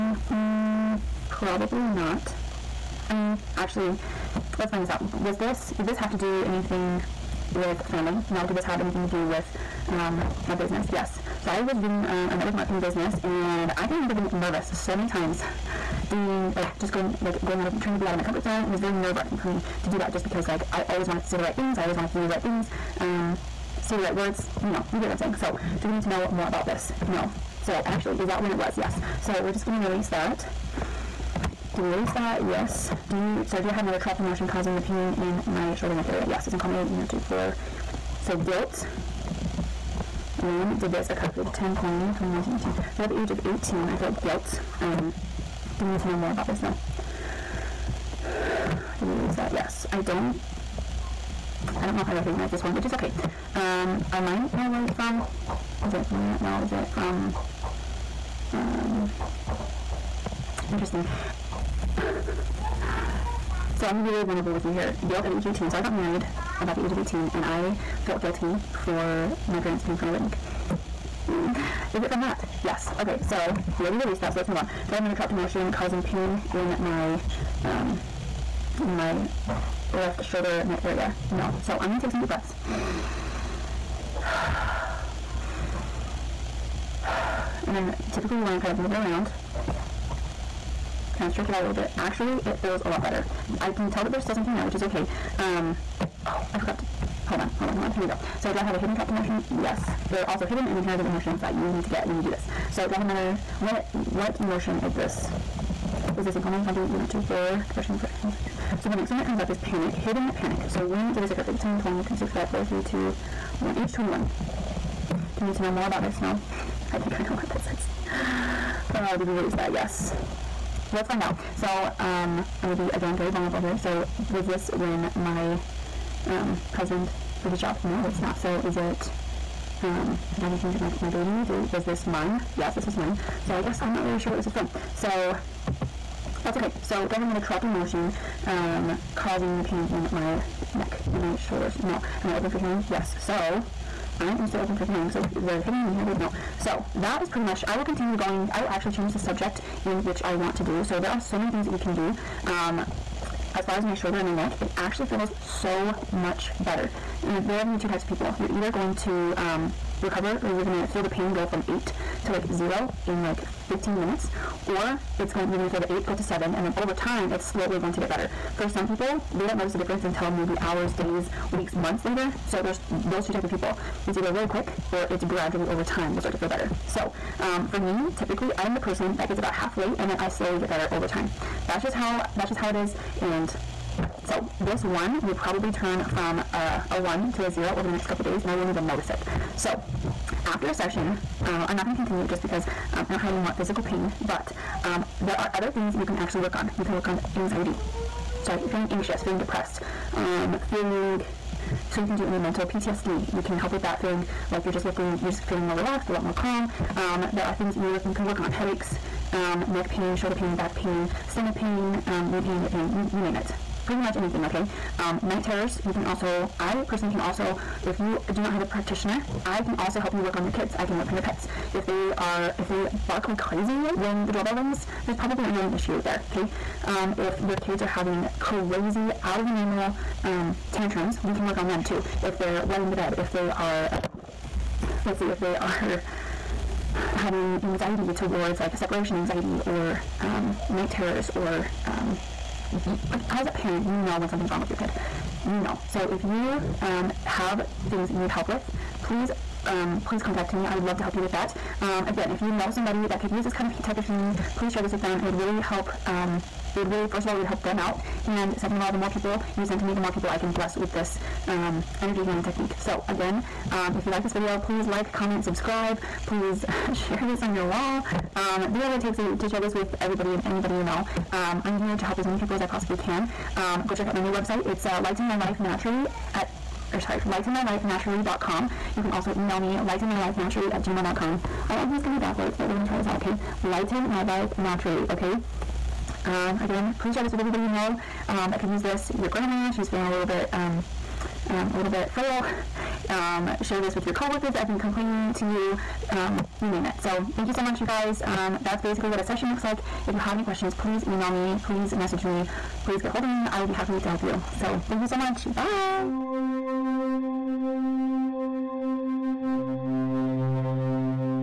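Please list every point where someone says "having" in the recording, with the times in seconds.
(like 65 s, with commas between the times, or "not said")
227 s, 237 s.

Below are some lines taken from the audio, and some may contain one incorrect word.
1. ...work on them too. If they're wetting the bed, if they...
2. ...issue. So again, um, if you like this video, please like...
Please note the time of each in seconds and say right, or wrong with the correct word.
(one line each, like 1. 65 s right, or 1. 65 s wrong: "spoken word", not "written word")
1. 231 s right
2. 262 s wrong: "technique", not "issue".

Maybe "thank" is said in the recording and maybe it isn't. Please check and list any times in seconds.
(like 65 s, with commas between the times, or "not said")
297 s, 304 s.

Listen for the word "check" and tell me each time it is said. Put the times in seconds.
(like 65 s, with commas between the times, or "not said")
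273 s.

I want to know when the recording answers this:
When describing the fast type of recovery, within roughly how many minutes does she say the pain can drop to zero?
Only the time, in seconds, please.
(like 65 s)
163 s.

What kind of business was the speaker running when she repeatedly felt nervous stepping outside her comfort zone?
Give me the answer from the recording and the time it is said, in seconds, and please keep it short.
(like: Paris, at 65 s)
network marketing, at 12 s.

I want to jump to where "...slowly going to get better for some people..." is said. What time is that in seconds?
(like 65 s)
167 s.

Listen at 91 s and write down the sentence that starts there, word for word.
Actually, it feels a lot better.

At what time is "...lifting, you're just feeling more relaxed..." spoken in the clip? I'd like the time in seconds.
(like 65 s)
204 s.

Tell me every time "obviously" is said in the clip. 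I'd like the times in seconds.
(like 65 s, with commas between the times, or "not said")
not said.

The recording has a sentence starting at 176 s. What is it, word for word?
So um, for me, typically I am the person that gets about halfway and then I slowly get better over time.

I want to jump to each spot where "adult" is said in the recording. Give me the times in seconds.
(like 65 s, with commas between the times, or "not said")
not said.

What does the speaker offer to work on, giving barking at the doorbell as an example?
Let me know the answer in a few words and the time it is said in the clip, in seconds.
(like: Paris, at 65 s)
pets, at 221 s.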